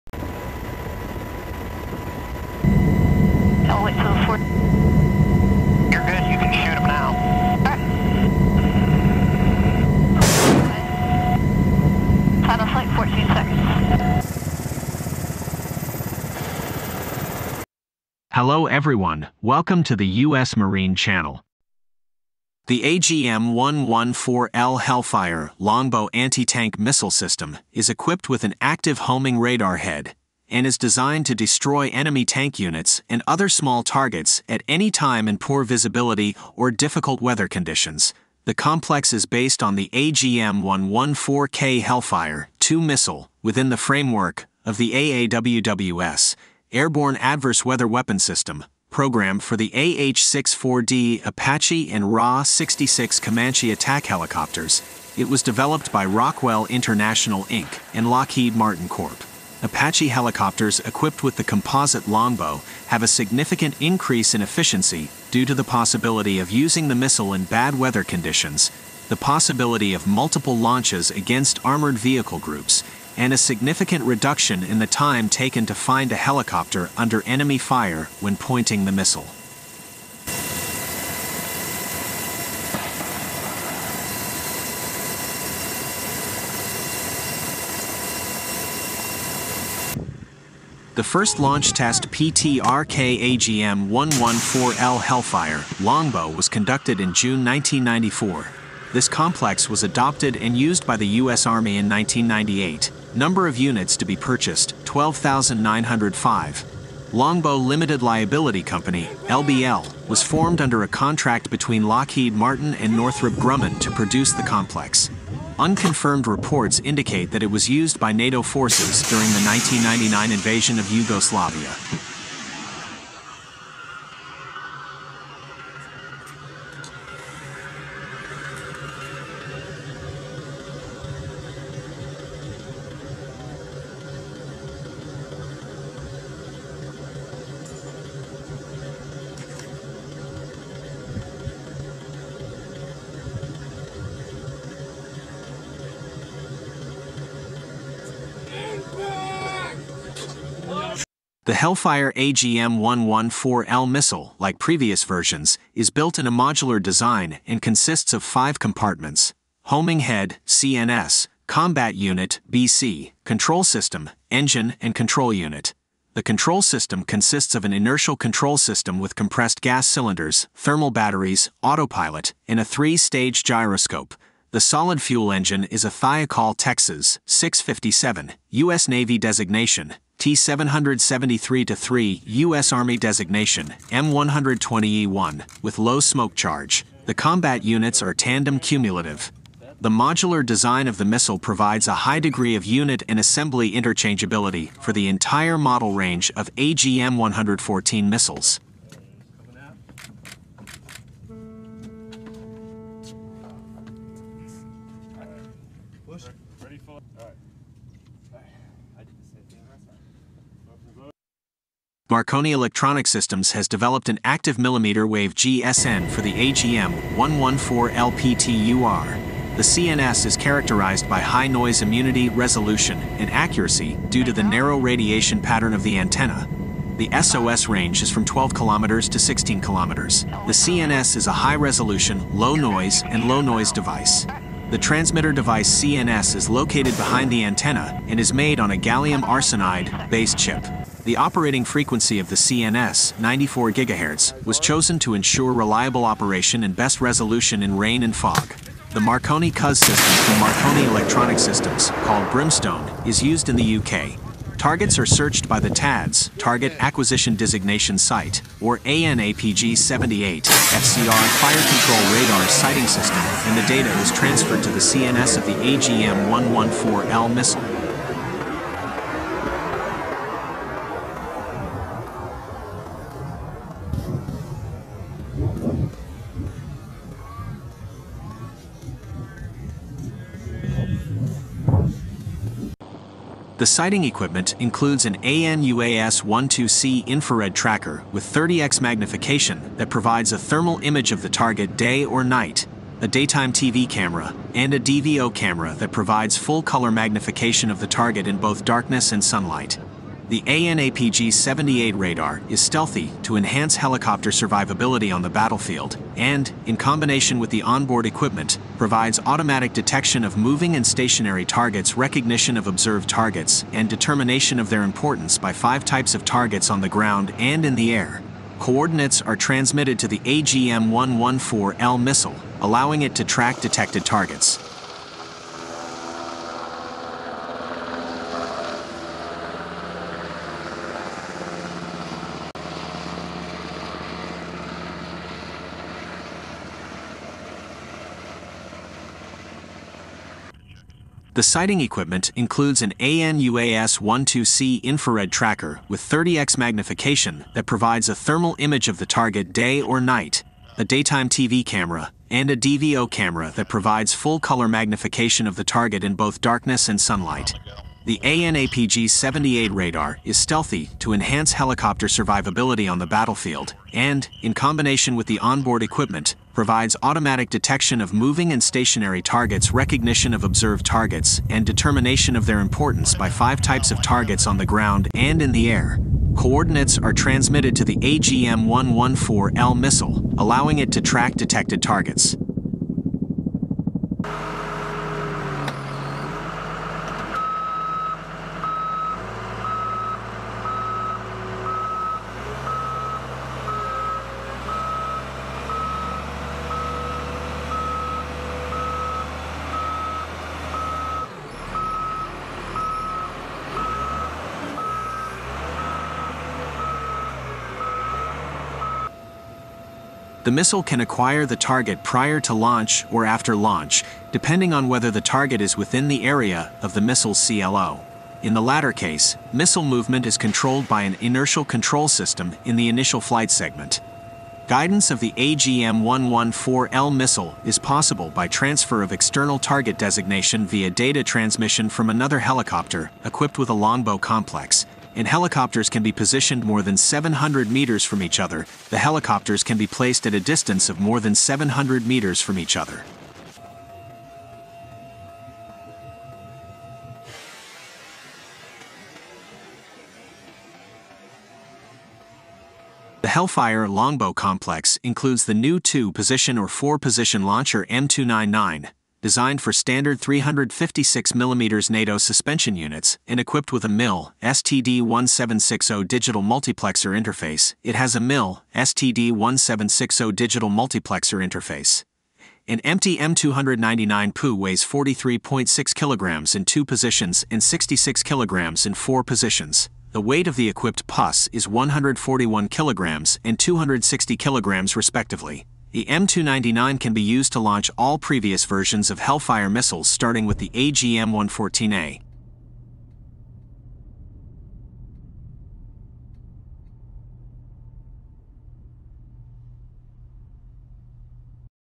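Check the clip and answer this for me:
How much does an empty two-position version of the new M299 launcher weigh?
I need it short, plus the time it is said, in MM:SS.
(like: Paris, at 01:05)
43.6 kilograms, at 07:54.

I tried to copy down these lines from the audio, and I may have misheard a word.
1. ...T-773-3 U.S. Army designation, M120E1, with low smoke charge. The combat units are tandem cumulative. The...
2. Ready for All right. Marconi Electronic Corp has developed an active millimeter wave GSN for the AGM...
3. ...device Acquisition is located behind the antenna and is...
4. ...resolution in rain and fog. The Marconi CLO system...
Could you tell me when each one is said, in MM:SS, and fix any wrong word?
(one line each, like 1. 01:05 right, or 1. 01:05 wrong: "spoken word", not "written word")
1. 03:00 right
2. 03:26 wrong: "Systems", not "Corp"
3. 03:55 wrong: "CNS", not "Acquisition"
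4. 04:07 wrong: "CUS", not "CLO".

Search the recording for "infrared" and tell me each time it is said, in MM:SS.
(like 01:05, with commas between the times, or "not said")
04:47, 05:44.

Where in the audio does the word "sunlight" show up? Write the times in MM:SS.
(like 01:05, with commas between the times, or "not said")
04:59, 05:56.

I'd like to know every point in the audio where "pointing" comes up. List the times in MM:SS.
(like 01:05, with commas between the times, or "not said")
01:18.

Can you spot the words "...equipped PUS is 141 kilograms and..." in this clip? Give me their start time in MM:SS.
08:00.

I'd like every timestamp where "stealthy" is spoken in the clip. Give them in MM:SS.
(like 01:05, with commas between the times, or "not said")
05:02, 06:00.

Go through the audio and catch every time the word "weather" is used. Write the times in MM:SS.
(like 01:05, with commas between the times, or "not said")
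00:37, 00:47, 01:07.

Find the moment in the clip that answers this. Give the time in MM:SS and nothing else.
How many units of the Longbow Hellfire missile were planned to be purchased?
01:44.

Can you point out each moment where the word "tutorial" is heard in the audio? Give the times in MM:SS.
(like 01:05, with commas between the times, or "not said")
not said.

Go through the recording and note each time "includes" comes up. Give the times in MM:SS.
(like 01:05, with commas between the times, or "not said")
04:44, 05:42, 07:35.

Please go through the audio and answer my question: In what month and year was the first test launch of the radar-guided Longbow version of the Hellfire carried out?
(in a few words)
June 1994.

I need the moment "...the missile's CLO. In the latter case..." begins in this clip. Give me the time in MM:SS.
06:56.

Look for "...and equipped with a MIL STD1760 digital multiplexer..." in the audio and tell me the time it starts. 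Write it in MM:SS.
07:43.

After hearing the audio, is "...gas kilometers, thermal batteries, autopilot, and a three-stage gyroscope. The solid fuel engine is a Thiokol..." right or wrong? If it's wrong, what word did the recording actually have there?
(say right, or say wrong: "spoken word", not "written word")
wrong: "cylinders", not "kilometers".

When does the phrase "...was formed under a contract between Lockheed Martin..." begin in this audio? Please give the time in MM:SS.
01:50.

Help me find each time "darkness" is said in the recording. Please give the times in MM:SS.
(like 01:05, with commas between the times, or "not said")
04:58, 05:56.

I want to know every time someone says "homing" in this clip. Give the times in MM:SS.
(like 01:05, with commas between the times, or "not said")
00:28, 02:39.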